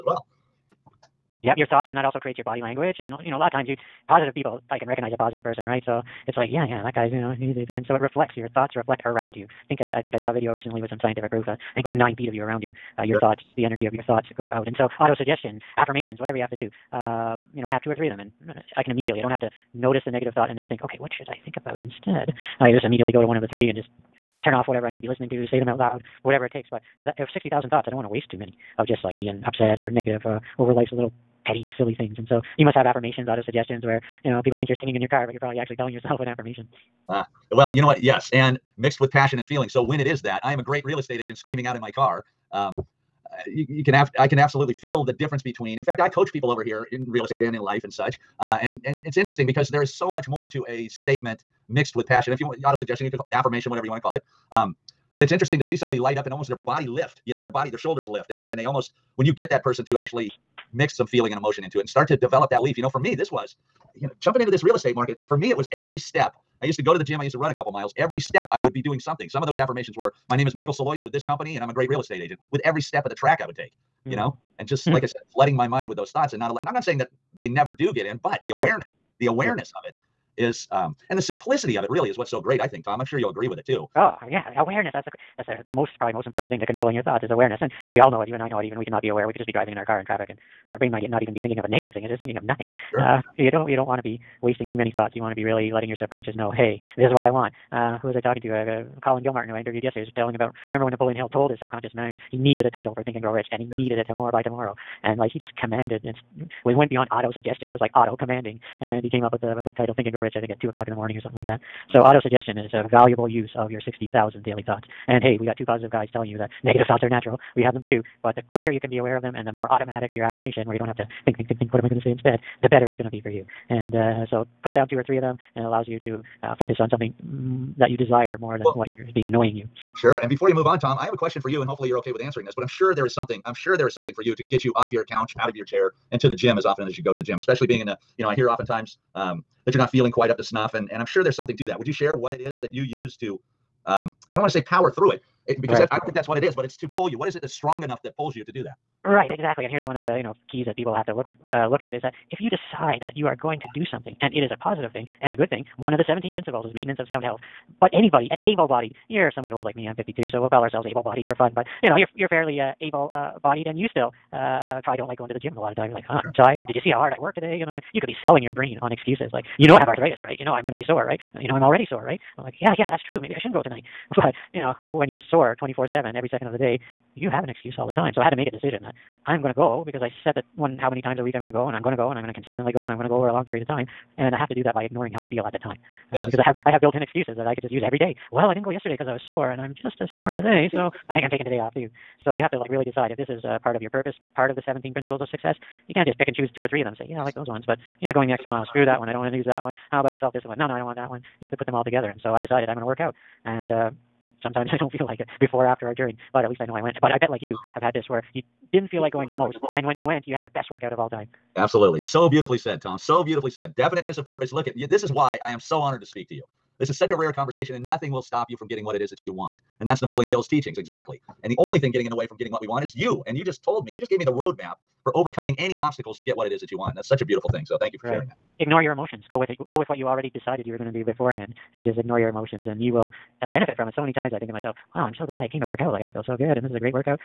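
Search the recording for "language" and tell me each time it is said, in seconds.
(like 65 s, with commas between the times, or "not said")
2 s.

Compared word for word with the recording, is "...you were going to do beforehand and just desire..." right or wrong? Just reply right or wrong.
wrong.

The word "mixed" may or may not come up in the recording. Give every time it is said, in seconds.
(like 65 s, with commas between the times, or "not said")
38 s, 51 s.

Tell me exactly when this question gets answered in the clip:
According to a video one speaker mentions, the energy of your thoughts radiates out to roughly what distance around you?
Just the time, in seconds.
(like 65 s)
11 s.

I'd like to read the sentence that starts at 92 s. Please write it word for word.
uh, you don't you don't want to be wasting too many thoughts.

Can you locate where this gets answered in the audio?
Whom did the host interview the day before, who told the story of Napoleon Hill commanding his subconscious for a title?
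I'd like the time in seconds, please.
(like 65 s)
99 s.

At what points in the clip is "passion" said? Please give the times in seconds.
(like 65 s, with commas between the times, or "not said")
39 s, 52 s.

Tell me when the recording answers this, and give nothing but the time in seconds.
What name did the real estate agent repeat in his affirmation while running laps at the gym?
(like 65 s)
70 s.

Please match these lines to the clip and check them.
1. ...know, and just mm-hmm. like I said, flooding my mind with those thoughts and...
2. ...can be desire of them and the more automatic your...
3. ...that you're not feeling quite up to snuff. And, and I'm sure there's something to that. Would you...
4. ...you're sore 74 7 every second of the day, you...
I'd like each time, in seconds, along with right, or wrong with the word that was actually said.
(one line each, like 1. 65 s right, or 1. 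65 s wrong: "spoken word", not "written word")
1. 74 s right
2. 118 s wrong: "aware", not "desire"
3. 139 s right
4. 175 s wrong: "24", not "74".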